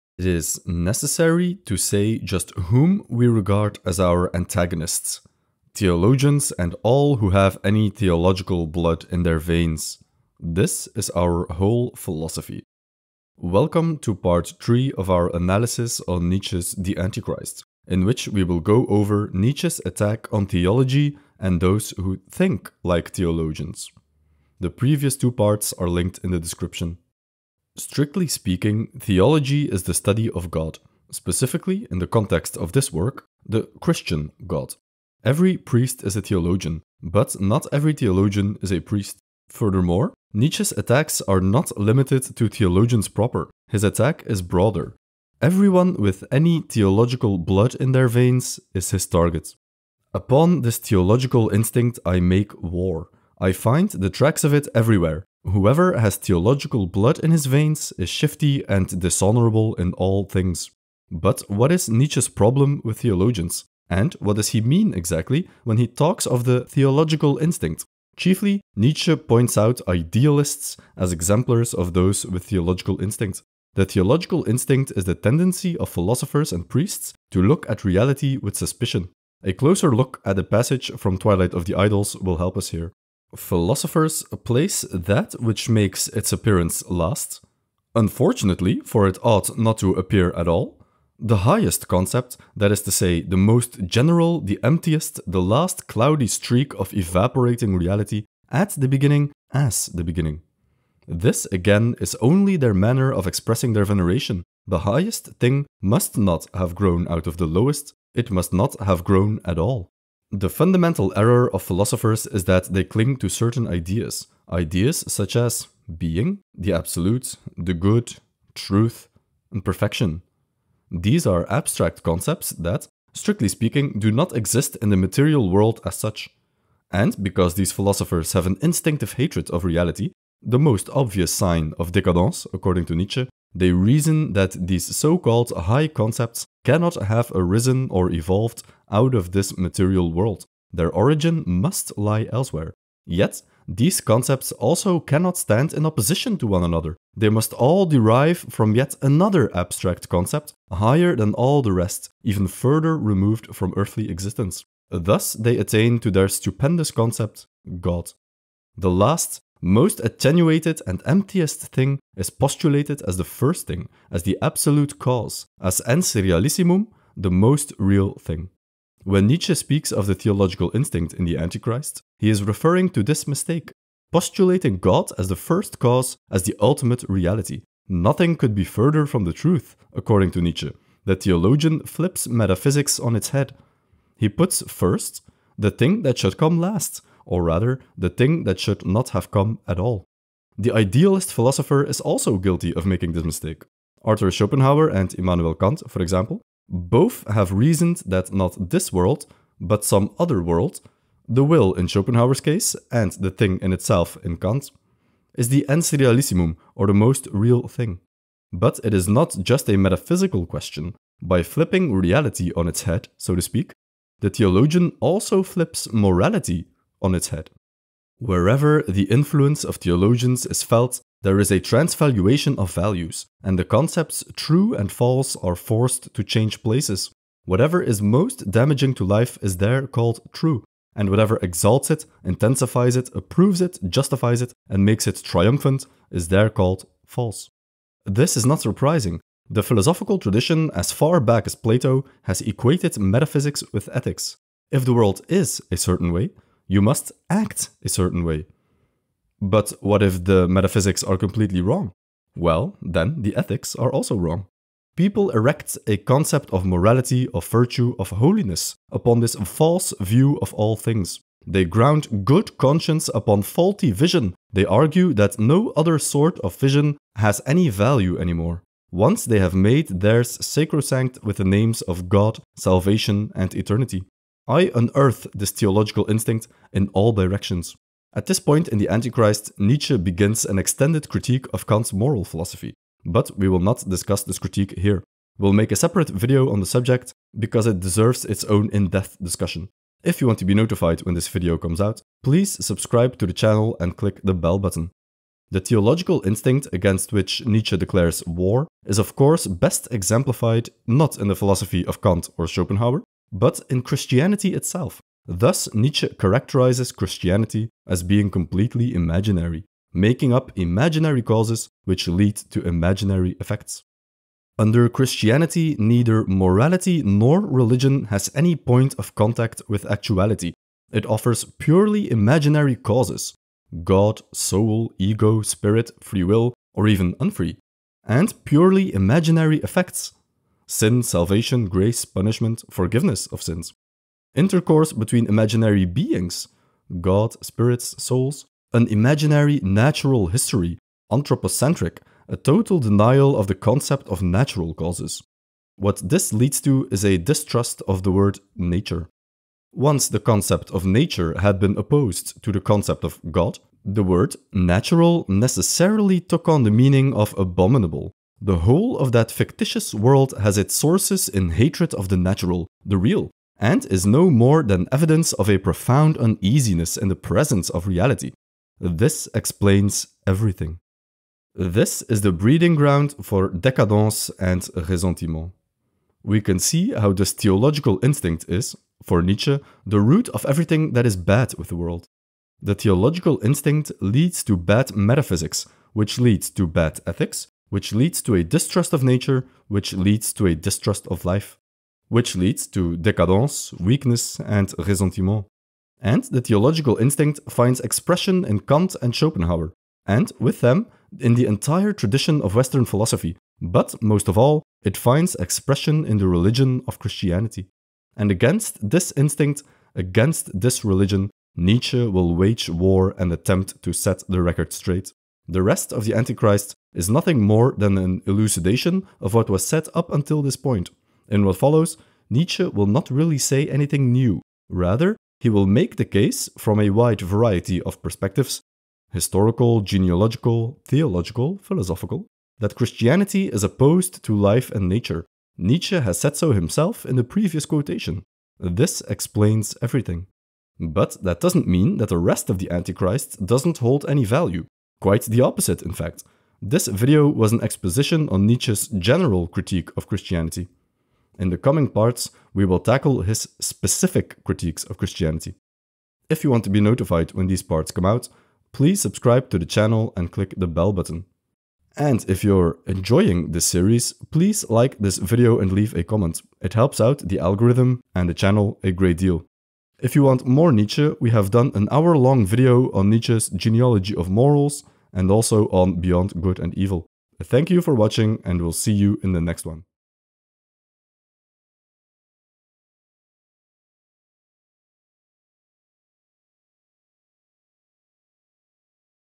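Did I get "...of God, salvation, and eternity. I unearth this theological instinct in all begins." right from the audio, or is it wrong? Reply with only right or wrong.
wrong.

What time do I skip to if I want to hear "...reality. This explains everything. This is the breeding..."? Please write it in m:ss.
6:07.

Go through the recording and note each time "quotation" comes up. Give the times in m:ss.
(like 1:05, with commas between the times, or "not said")
7:17.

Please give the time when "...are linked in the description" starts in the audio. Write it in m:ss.
0:25.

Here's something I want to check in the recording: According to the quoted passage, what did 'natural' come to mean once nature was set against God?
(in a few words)
abominable.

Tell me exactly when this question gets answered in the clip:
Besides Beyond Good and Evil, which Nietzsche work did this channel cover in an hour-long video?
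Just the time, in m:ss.
7:53.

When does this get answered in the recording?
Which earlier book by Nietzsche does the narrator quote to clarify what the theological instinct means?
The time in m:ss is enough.
1:21.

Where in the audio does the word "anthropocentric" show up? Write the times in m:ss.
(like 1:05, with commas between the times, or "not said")
5:41.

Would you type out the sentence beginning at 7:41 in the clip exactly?
And if you're enjoying this series, please like this video and leave a comment.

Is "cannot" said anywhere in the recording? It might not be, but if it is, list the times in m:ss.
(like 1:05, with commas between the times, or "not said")
2:16, 2:24.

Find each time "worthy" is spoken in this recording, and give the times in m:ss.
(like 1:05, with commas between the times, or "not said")
not said.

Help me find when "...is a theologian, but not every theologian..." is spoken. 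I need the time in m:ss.
0:36.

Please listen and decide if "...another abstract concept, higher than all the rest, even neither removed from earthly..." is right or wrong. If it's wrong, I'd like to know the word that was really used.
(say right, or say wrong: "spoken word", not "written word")
wrong: "further", not "neither".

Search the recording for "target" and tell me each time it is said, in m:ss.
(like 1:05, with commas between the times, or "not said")
0:49.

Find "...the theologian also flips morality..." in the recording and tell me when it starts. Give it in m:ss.
3:34.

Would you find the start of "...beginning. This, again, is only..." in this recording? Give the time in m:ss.
1:40.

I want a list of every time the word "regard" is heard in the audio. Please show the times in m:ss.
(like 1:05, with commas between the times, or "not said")
0:03.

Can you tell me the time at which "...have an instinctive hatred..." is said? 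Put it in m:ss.
2:08.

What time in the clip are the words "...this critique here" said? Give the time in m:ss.
4:44.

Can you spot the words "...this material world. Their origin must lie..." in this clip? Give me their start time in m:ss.
2:19.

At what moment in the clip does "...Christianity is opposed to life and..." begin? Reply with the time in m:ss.
7:12.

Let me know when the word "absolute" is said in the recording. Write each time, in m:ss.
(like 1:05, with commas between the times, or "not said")
1:56, 2:44.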